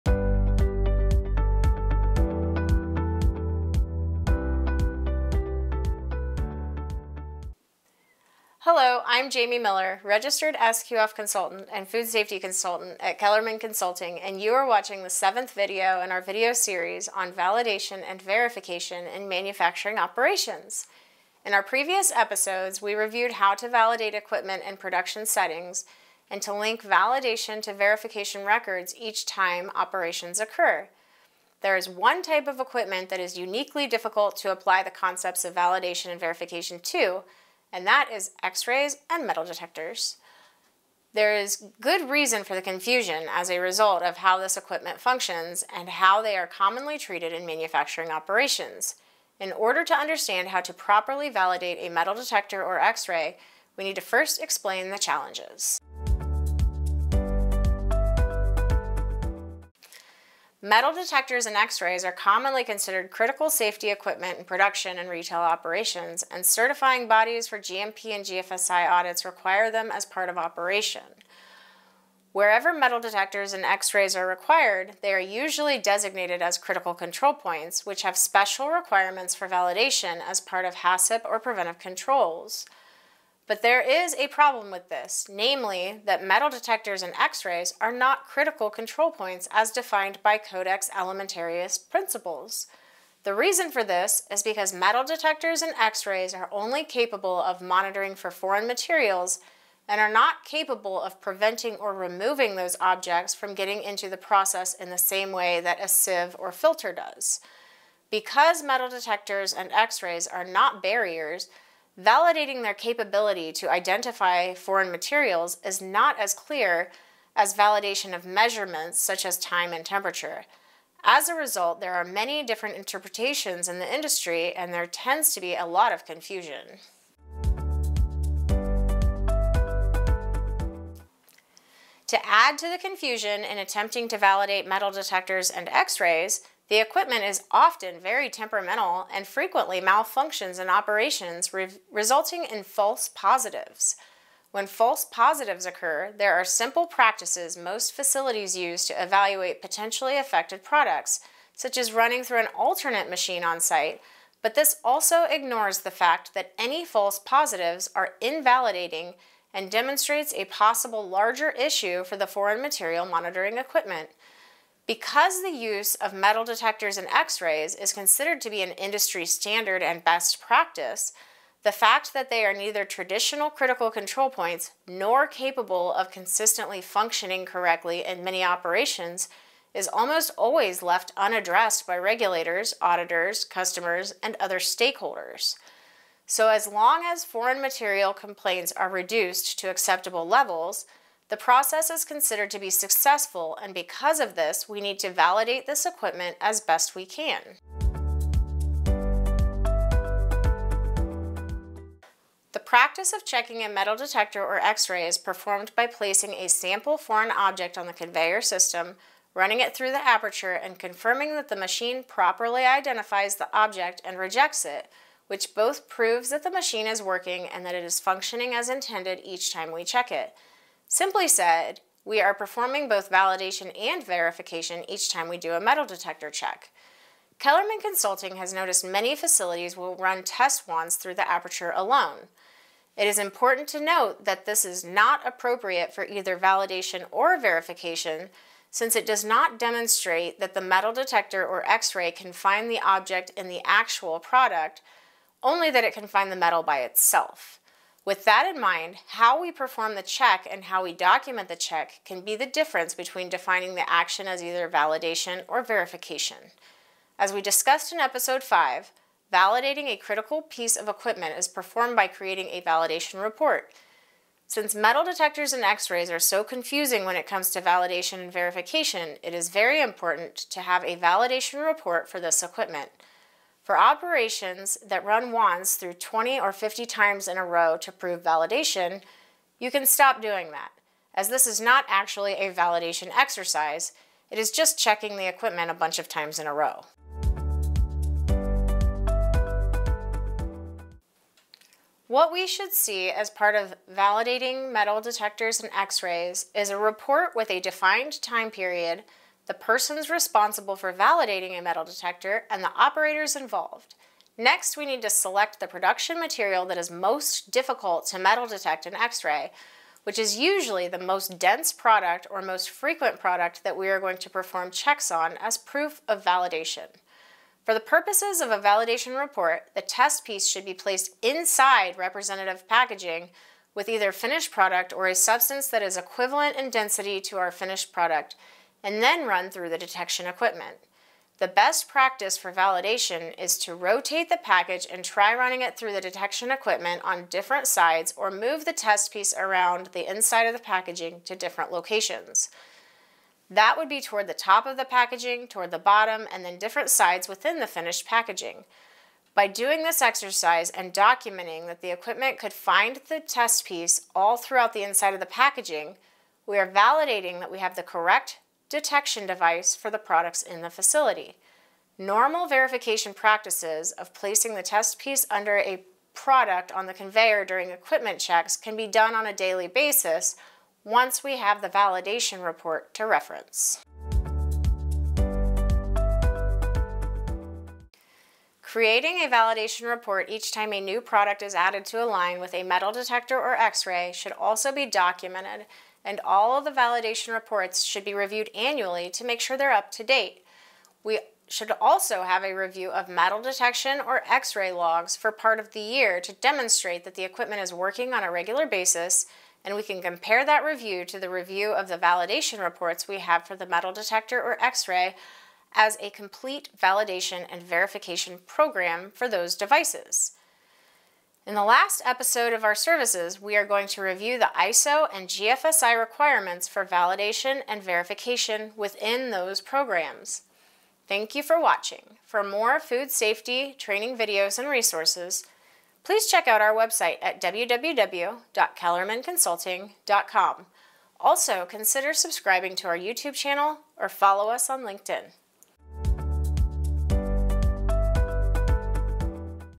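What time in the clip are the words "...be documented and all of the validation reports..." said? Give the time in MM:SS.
06:24.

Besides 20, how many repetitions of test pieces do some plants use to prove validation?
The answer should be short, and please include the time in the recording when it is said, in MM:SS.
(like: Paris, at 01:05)
50, at 04:36.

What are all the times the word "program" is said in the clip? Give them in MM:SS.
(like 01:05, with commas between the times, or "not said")
06:48, 06:59.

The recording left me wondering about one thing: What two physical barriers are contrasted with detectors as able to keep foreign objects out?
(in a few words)
a sieve or filter.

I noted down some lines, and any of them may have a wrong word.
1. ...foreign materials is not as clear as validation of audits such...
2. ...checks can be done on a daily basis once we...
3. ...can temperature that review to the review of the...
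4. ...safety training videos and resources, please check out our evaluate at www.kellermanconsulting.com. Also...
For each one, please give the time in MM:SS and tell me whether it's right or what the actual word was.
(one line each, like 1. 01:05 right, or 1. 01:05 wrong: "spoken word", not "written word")
1. 01:54 wrong: "measurements", not "audits"
2. 06:08 right
3. 06:39 wrong: "compare", not "temperature"
4. 07:03 wrong: "website", not "evaluate".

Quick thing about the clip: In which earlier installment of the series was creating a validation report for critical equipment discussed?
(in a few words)
episode 5.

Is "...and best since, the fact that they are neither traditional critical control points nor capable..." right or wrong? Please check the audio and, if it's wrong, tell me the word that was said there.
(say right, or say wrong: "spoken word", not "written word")
wrong: "practice", not "since".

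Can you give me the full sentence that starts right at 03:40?
Simply said, we are performing both validation and verification each time we do a metal detector check.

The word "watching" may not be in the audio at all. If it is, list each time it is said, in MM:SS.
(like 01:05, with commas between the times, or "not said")
00:14, 07:01.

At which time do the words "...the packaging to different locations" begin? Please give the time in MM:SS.
05:40.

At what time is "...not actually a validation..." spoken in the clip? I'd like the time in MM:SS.
04:41.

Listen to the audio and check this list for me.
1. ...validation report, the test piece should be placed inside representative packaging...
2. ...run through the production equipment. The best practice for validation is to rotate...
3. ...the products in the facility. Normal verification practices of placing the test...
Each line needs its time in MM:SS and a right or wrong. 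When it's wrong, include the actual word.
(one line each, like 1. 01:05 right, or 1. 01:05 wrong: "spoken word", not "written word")
1. 05:18 right
2. 05:29 wrong: "detection", not "production"
3. 05:59 right.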